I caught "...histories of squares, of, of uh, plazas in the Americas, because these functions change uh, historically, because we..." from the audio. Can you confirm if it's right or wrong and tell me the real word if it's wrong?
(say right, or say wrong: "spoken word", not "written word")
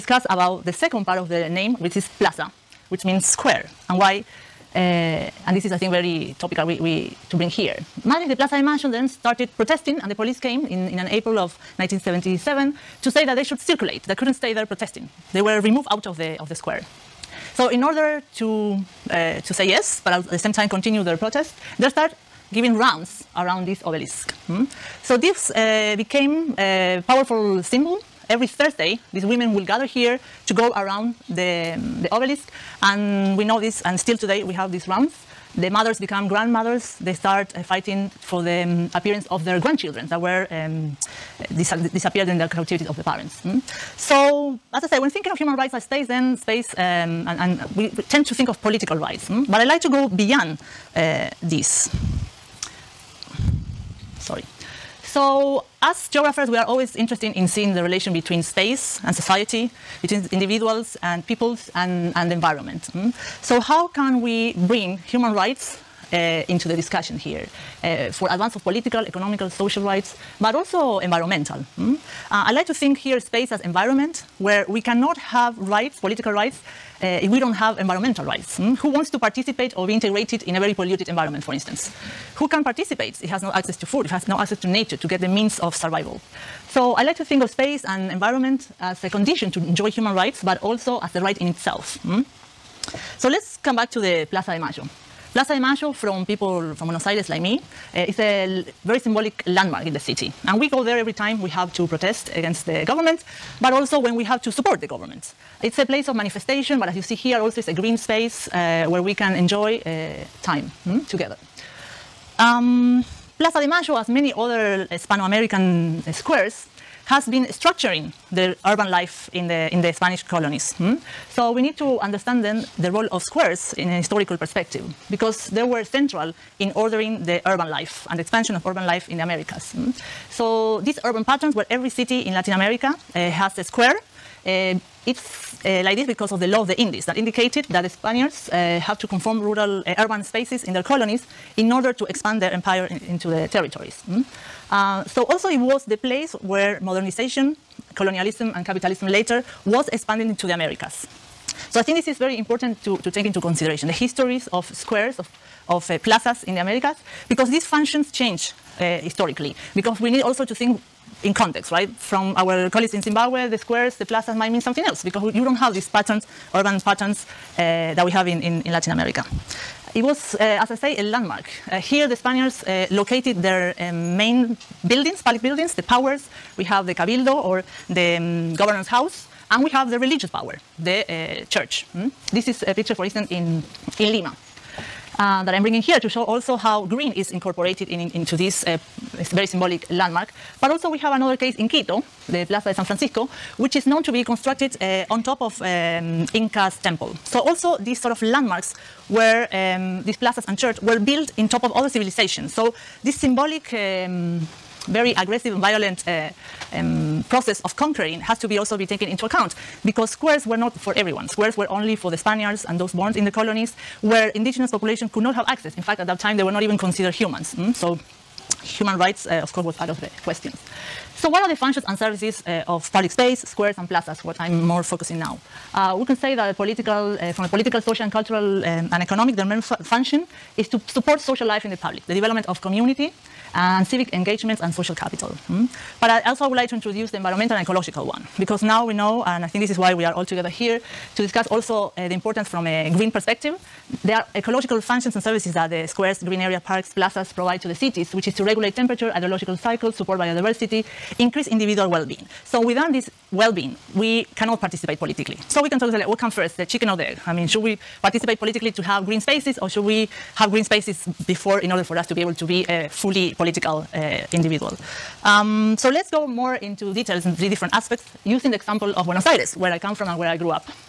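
right.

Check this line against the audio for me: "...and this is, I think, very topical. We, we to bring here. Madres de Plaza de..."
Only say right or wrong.
right.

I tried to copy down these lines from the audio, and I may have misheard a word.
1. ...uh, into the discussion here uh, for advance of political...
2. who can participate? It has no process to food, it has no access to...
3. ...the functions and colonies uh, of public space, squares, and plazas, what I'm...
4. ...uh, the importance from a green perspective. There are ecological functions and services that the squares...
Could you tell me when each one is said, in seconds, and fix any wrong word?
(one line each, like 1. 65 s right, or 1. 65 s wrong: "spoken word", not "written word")
1. 66 s right
2. 82 s wrong: "access", not "process"
3. 221 s wrong: "services", not "colonies"
4. 241 s right.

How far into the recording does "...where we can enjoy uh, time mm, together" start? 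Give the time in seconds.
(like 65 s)
108 s.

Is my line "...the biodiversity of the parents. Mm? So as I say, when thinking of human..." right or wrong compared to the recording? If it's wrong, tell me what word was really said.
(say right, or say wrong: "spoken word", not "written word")
wrong: "captivity", not "biodiversity".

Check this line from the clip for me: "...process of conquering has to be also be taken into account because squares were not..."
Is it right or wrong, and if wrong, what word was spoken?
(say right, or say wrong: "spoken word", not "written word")
right.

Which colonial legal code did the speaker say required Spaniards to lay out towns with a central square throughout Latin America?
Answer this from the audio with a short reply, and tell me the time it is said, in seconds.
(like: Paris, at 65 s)
The law of the Indies, at 136 s.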